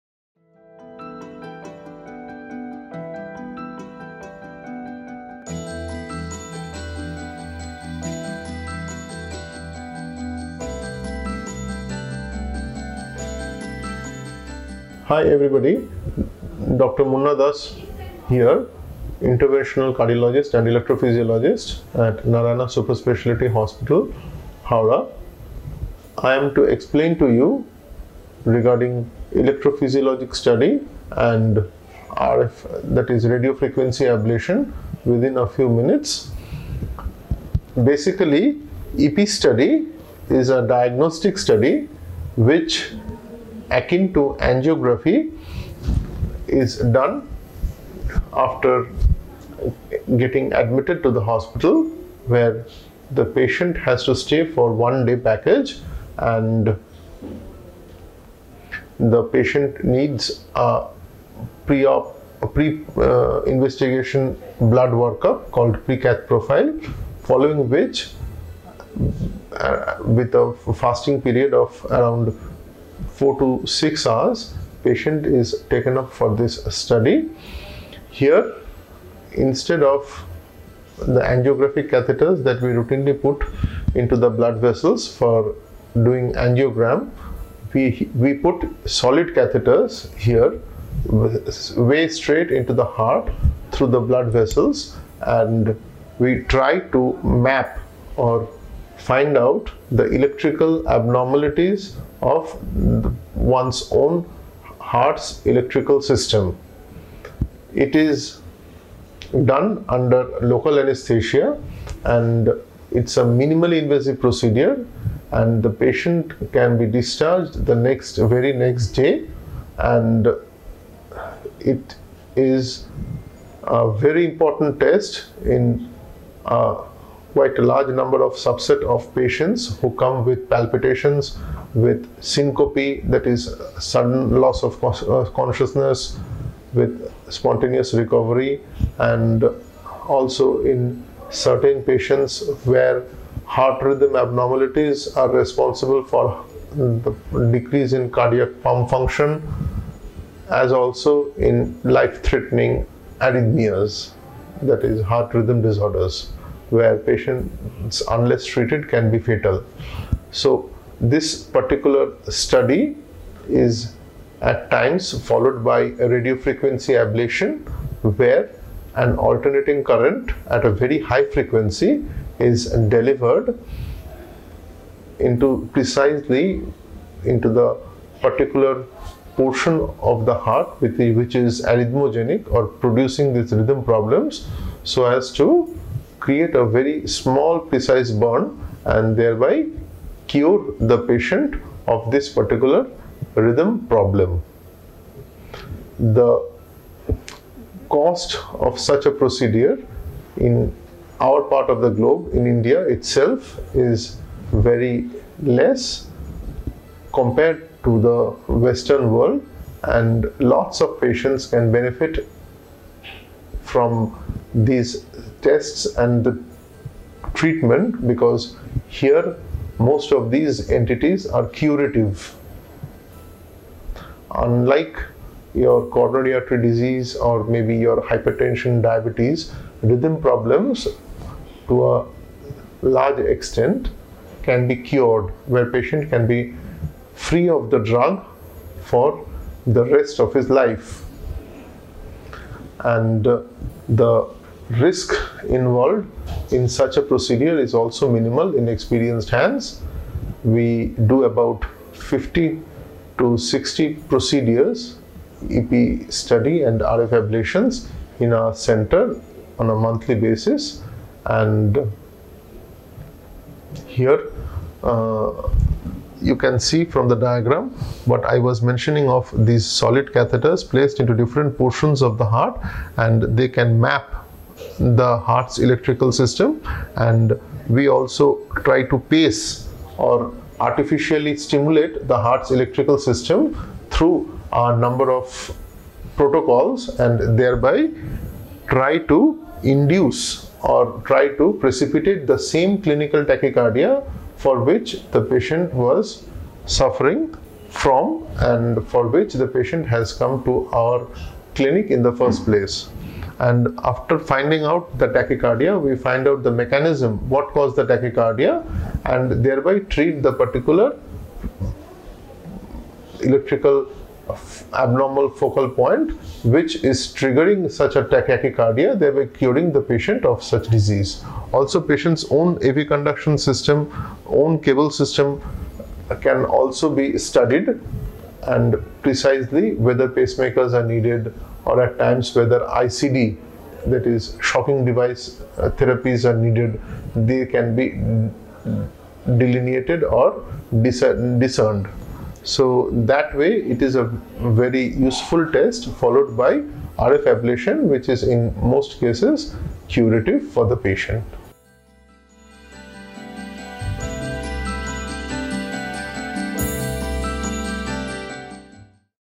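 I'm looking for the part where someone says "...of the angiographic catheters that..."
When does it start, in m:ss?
1:19.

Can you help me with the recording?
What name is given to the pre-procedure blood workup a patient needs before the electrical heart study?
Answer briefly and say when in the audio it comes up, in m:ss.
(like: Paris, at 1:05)
pre-cath profile, at 1:05.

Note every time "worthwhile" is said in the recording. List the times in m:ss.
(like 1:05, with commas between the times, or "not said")
not said.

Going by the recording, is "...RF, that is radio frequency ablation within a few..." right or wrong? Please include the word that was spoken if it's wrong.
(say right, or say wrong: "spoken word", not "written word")
right.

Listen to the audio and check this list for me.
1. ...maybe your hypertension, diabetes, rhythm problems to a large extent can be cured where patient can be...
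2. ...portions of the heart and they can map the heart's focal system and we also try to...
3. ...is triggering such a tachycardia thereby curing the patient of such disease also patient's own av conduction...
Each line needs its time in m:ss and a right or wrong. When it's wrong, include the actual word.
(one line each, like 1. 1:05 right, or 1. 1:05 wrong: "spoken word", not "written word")
1. 3:47 right
2. 4:31 wrong: "electrical", not "focal"
3. 5:16 right.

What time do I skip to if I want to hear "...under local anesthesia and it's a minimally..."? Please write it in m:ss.
1:49.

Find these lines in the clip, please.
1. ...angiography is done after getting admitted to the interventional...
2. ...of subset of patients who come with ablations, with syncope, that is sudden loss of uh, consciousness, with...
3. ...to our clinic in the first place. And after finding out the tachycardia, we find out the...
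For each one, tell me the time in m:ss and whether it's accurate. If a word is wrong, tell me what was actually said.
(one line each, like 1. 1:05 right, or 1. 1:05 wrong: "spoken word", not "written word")
1. 0:44 wrong: "hospital", not "interventional"
2. 2:08 wrong: "palpitations", not "ablations"
3. 5:00 right.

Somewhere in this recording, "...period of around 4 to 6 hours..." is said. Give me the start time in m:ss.
1:11.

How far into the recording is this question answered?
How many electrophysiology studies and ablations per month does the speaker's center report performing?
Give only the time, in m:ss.
4:11.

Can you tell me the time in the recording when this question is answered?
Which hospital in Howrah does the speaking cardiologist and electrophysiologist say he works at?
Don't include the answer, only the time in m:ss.
0:22.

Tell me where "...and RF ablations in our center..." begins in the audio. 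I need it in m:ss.
4:16.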